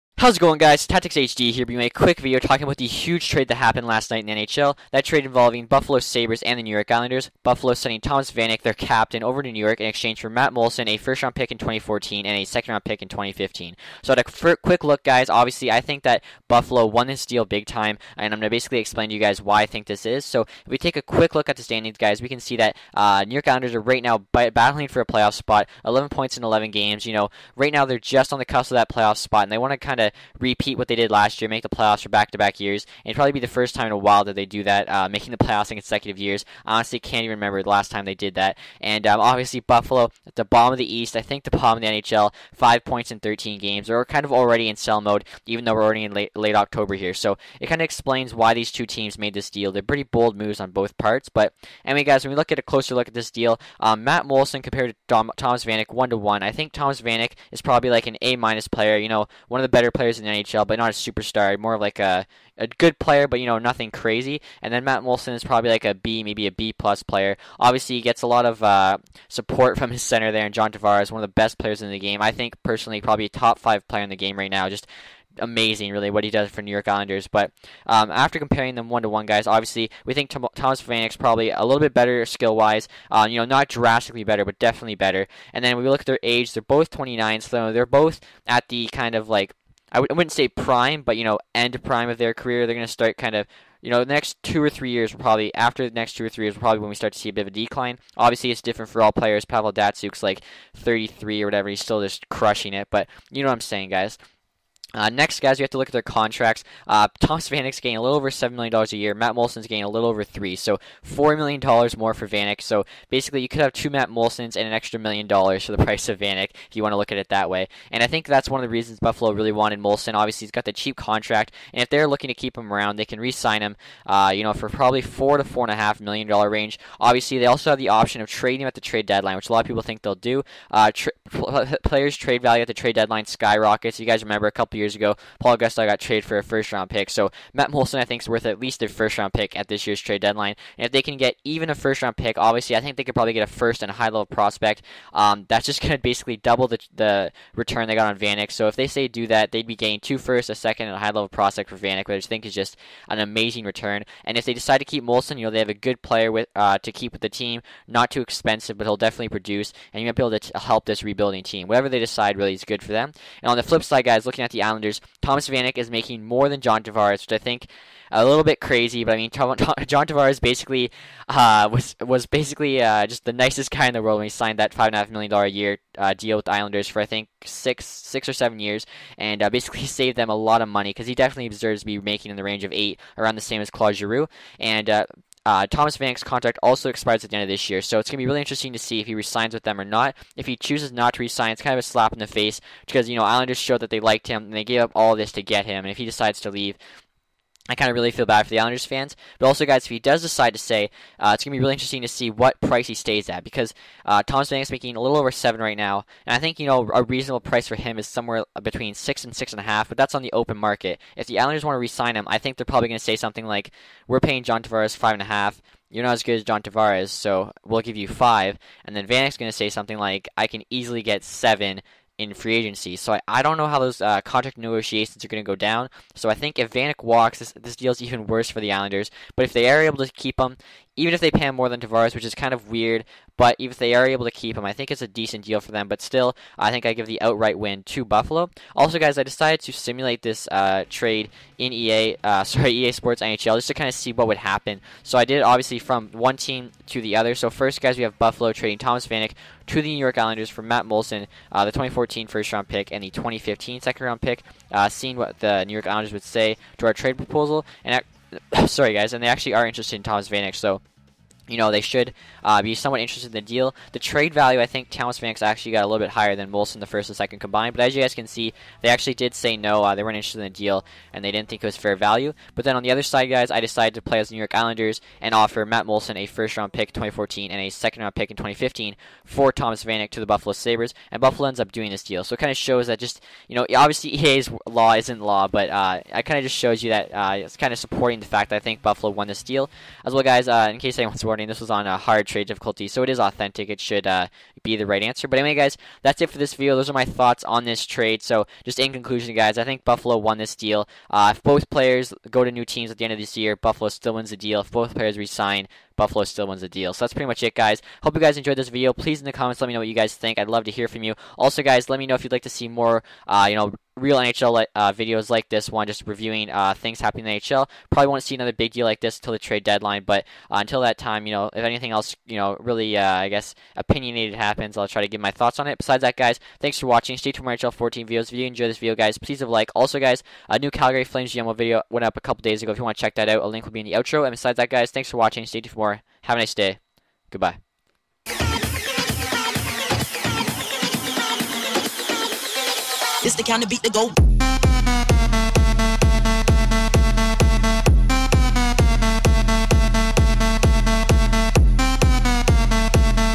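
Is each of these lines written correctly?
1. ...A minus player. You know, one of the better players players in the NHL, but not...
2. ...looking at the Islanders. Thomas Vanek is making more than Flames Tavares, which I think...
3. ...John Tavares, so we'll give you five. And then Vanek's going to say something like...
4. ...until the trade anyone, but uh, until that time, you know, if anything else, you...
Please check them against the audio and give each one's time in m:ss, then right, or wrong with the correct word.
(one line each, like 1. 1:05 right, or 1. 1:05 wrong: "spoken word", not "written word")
1. 0:58 right
2. 2:44 wrong: "John", not "Flames"
3. 3:36 right
4. 5:19 wrong: "deadline", not "anyone".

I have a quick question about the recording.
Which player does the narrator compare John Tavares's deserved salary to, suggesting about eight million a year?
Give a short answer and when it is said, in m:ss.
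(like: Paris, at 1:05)
Claude Giroux, at 3:03.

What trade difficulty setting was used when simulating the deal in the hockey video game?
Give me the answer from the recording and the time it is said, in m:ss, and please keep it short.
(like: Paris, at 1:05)
hard, at 4:51.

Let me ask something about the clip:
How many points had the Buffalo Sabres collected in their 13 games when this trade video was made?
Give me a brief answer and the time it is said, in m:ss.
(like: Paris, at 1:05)
5, at 0:42.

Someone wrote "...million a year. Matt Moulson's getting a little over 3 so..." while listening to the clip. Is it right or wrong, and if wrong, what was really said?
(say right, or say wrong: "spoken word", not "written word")
right.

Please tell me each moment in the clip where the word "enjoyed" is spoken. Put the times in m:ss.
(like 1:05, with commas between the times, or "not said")
5:08, 5:28.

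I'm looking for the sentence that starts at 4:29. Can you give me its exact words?
Uh, they weren't interested in the deal, and they didn't think it was fair value.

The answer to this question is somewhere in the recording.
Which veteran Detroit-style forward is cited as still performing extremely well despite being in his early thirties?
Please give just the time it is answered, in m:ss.
1:39.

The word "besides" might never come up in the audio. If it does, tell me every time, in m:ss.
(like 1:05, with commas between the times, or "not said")
5:25, 5:34.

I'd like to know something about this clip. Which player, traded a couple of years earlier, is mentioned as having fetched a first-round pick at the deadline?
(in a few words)
Paul Gaustad.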